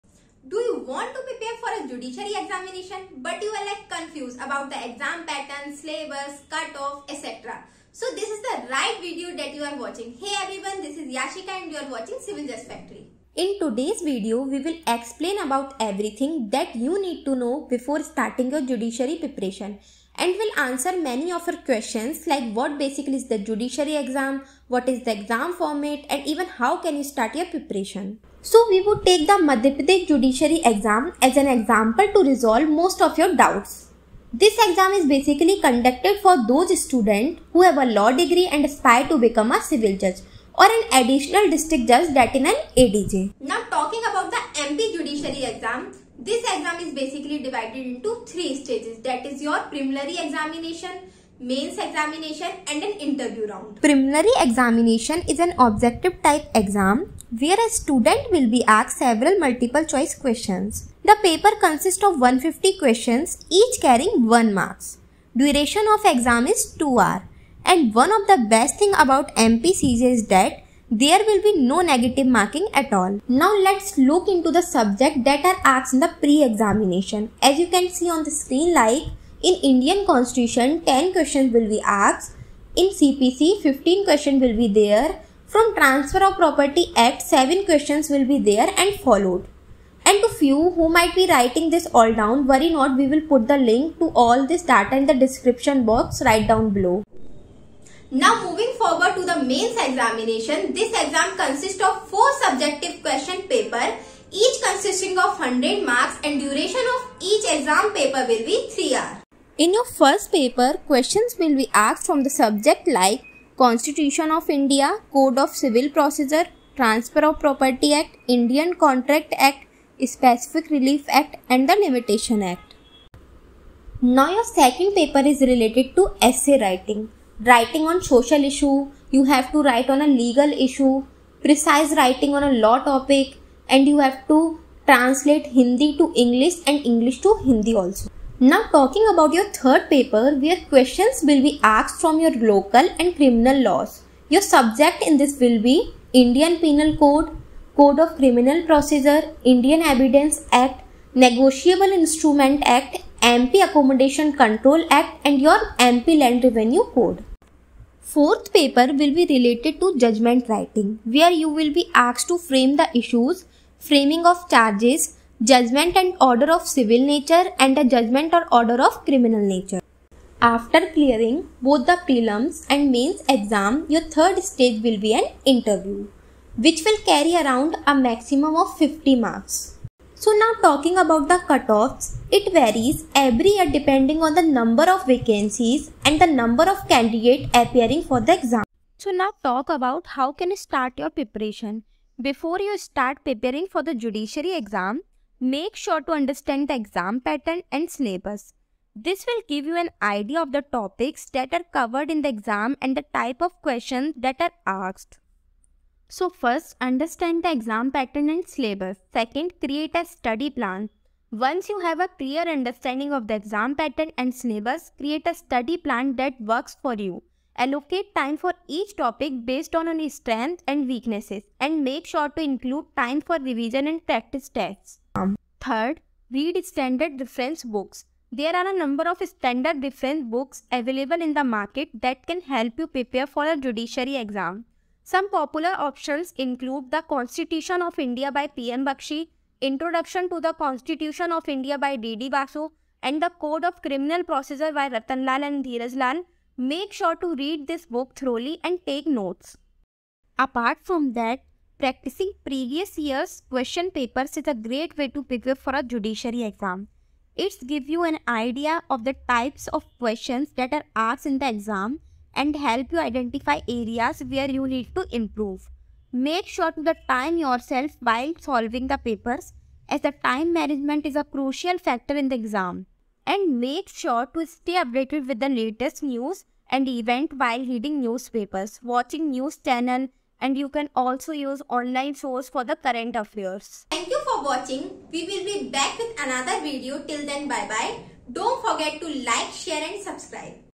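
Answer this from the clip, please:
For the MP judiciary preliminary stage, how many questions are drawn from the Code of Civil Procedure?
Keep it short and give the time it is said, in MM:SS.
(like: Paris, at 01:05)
15, at 01:23.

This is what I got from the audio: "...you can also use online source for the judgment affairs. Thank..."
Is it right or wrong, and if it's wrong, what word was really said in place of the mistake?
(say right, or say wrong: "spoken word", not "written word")
wrong: "current", not "judgment".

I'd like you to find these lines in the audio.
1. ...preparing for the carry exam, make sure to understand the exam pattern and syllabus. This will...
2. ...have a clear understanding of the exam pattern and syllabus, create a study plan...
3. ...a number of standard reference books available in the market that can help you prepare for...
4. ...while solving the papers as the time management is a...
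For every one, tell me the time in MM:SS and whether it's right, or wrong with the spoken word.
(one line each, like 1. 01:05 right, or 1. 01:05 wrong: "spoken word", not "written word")
1. 03:13 wrong: "judiciary", not "carry"
2. 03:31 right
3. 03:48 right
4. 04:28 right.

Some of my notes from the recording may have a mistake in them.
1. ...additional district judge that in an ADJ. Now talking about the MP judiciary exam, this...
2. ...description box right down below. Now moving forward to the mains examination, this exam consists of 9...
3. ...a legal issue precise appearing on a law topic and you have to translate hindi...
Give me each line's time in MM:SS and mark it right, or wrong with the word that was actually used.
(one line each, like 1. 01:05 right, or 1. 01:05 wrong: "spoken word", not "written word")
1. 00:40 right
2. 01:35 wrong: "4", not "9"
3. 02:10 wrong: "writing", not "appearing".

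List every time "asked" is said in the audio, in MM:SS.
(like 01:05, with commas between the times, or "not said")
00:58, 01:15, 01:21, 01:51, 02:21, 02:41, 03:24, 04:20.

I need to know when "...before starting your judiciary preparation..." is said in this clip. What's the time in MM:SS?
00:17.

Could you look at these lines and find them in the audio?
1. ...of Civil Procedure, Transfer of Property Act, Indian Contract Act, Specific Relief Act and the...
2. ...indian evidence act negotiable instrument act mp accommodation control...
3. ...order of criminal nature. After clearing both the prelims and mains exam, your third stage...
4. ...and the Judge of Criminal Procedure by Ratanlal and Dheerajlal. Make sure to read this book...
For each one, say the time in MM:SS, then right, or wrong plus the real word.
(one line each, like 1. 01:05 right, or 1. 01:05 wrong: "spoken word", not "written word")
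1. 01:55 right
2. 02:29 right
3. 02:48 right
4. 04:03 wrong: "Code", not "Judge".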